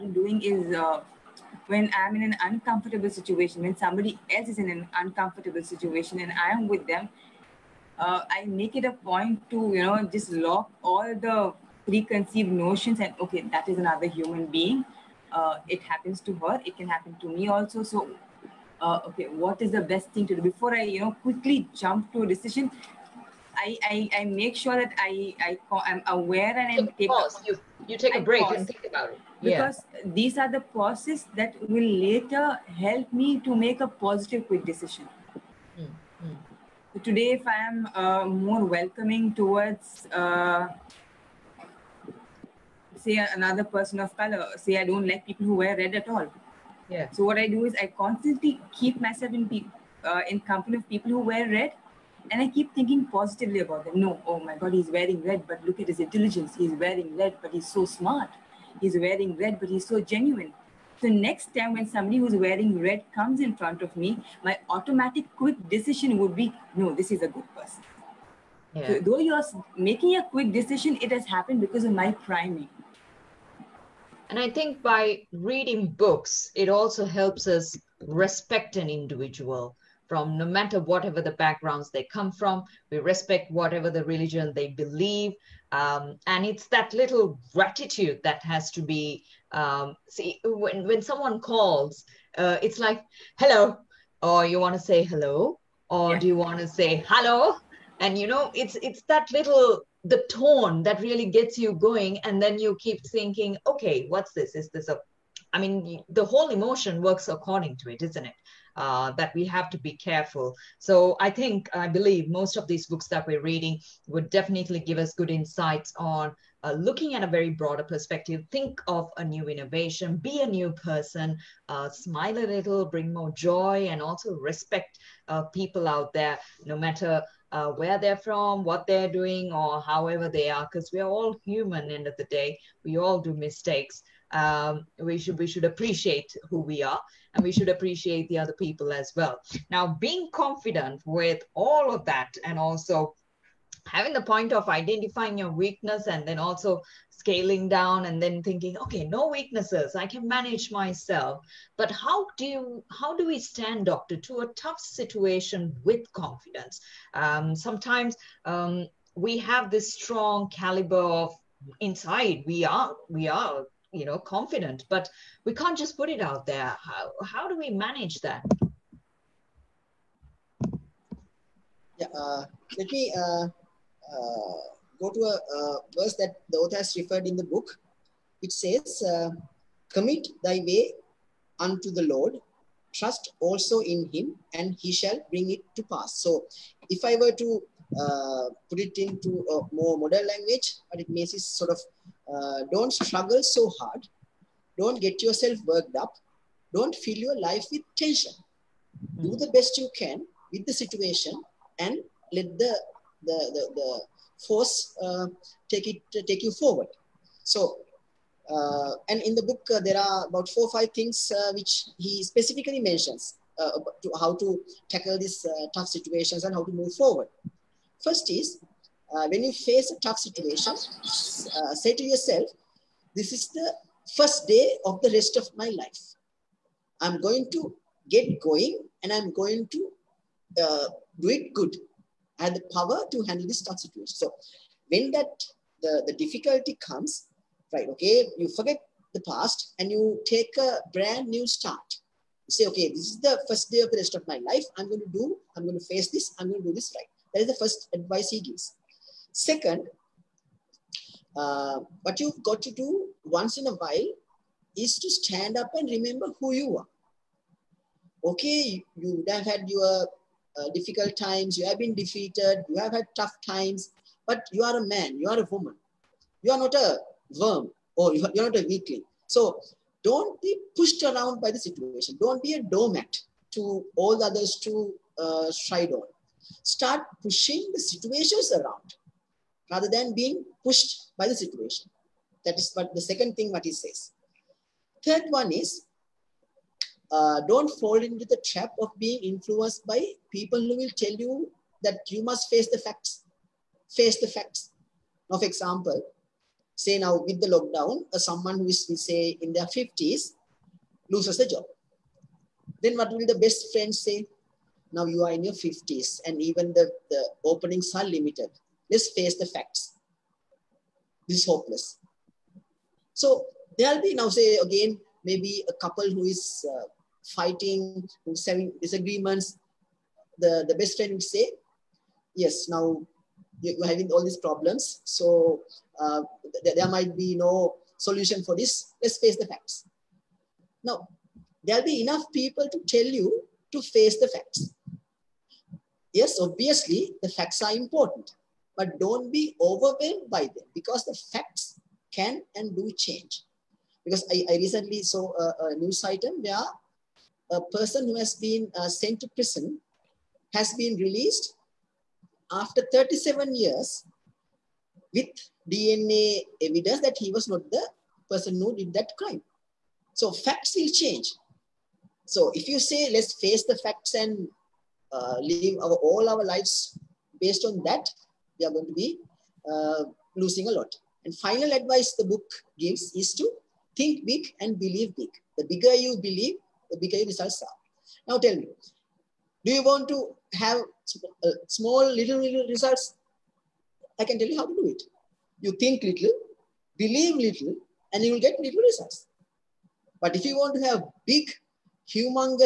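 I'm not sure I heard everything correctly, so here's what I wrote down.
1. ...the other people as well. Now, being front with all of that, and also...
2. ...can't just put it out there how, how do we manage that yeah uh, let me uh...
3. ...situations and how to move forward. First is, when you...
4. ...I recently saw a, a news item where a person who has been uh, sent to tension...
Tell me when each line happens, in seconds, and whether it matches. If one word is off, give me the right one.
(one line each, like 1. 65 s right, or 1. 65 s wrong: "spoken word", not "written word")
1. 138 s wrong: "confident", not "front"
2. 165 s right
3. 215 s right
4. 344 s wrong: "prison", not "tension".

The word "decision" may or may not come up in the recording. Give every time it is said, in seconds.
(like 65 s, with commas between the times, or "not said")
22 s, 34 s, 65 s, 70 s.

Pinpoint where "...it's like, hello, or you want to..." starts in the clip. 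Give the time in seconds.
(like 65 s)
92 s.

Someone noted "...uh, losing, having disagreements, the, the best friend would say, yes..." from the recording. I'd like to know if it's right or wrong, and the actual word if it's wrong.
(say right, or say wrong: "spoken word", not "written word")
wrong: "fighting", not "losing".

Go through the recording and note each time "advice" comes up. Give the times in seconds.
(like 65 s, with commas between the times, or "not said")
247 s, 371 s.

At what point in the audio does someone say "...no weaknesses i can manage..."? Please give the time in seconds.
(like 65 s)
149 s.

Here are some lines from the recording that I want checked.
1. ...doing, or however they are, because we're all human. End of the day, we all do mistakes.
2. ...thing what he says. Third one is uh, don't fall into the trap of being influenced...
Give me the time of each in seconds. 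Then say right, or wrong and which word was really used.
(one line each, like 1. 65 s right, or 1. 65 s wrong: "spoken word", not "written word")
1. 129 s right
2. 283 s right.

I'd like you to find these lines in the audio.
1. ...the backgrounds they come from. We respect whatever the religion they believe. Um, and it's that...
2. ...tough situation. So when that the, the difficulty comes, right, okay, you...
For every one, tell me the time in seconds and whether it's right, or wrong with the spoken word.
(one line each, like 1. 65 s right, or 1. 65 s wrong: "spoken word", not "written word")
1. 81 s right
2. 233 s right.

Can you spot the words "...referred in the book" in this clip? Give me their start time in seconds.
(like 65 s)
176 s.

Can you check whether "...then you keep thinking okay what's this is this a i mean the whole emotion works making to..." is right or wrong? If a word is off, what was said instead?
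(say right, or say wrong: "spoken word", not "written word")
wrong: "according", not "making".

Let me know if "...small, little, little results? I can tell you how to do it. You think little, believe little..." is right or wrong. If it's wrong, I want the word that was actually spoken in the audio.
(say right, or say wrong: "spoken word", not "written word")
right.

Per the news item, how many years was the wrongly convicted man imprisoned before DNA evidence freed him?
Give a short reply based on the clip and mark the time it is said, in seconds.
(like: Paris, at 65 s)
37, at 352 s.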